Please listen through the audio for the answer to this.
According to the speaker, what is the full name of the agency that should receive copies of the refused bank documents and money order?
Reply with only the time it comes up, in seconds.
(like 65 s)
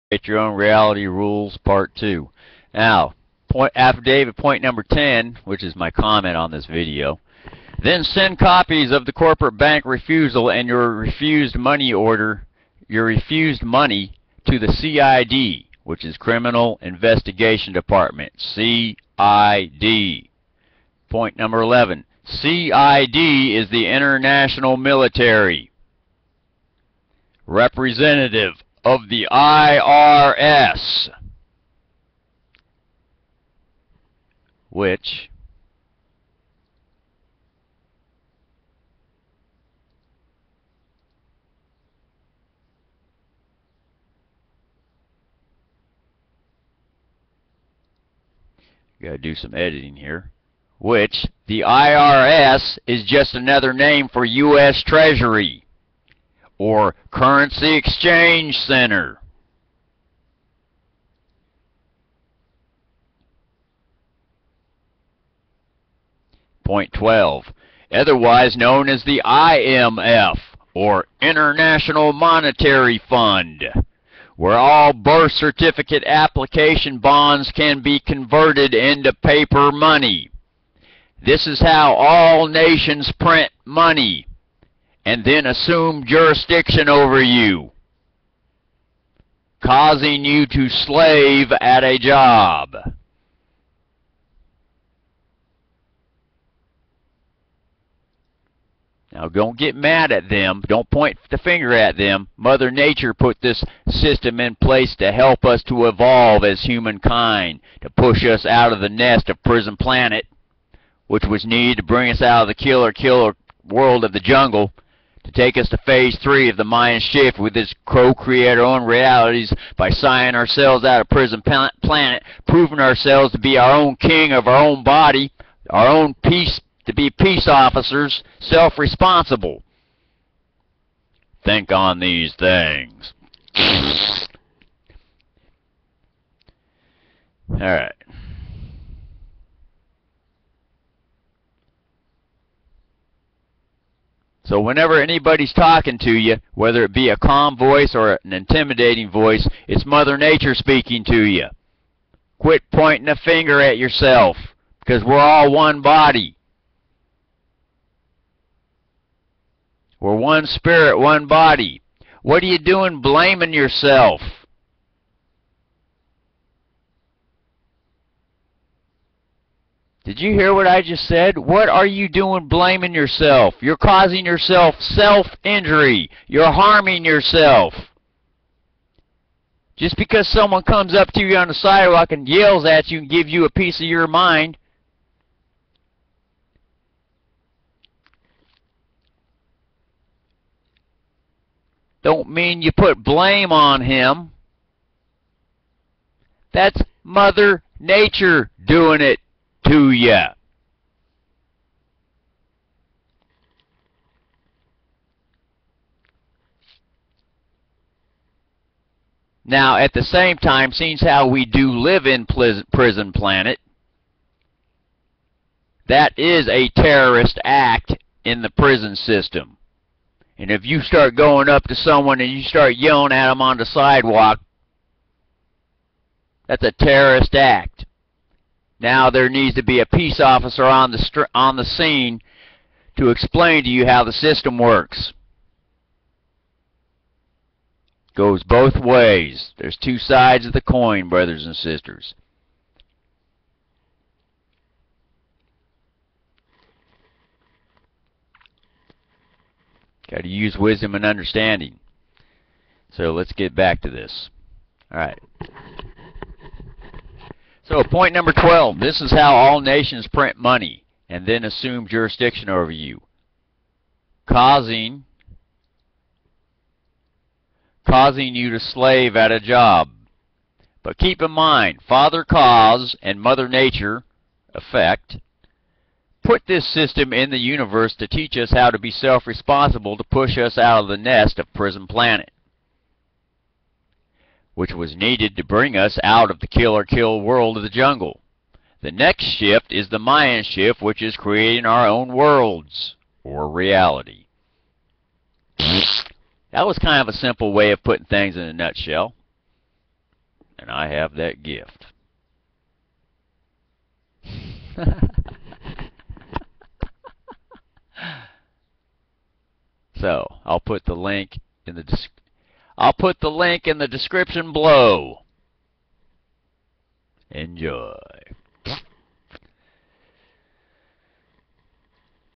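16 s.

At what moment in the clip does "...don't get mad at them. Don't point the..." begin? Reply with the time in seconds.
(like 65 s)
99 s.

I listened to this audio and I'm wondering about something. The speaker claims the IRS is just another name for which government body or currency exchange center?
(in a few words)
U.S. Treasury.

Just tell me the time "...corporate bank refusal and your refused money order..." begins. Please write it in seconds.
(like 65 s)
9 s.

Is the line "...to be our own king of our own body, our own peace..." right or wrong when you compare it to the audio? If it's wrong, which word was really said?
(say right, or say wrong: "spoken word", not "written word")
right.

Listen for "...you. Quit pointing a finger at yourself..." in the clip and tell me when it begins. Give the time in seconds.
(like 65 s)
151 s.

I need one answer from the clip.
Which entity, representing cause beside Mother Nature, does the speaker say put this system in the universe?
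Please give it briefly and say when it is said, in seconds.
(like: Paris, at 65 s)
Father Cause, at 271 s.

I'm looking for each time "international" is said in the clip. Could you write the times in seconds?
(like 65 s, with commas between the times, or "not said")
23 s, 71 s.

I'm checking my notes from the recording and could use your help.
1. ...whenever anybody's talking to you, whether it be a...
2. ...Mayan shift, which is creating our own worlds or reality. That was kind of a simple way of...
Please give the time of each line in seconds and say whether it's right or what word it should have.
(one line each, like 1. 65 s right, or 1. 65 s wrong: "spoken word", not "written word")
1. 144 s right
2. 289 s right.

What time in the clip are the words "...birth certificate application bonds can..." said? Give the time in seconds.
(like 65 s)
74 s.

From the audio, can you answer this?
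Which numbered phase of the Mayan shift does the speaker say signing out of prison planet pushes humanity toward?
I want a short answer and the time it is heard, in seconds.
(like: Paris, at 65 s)
Phase three, at 115 s.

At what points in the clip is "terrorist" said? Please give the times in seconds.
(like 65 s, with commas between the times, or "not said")
216 s, 226 s.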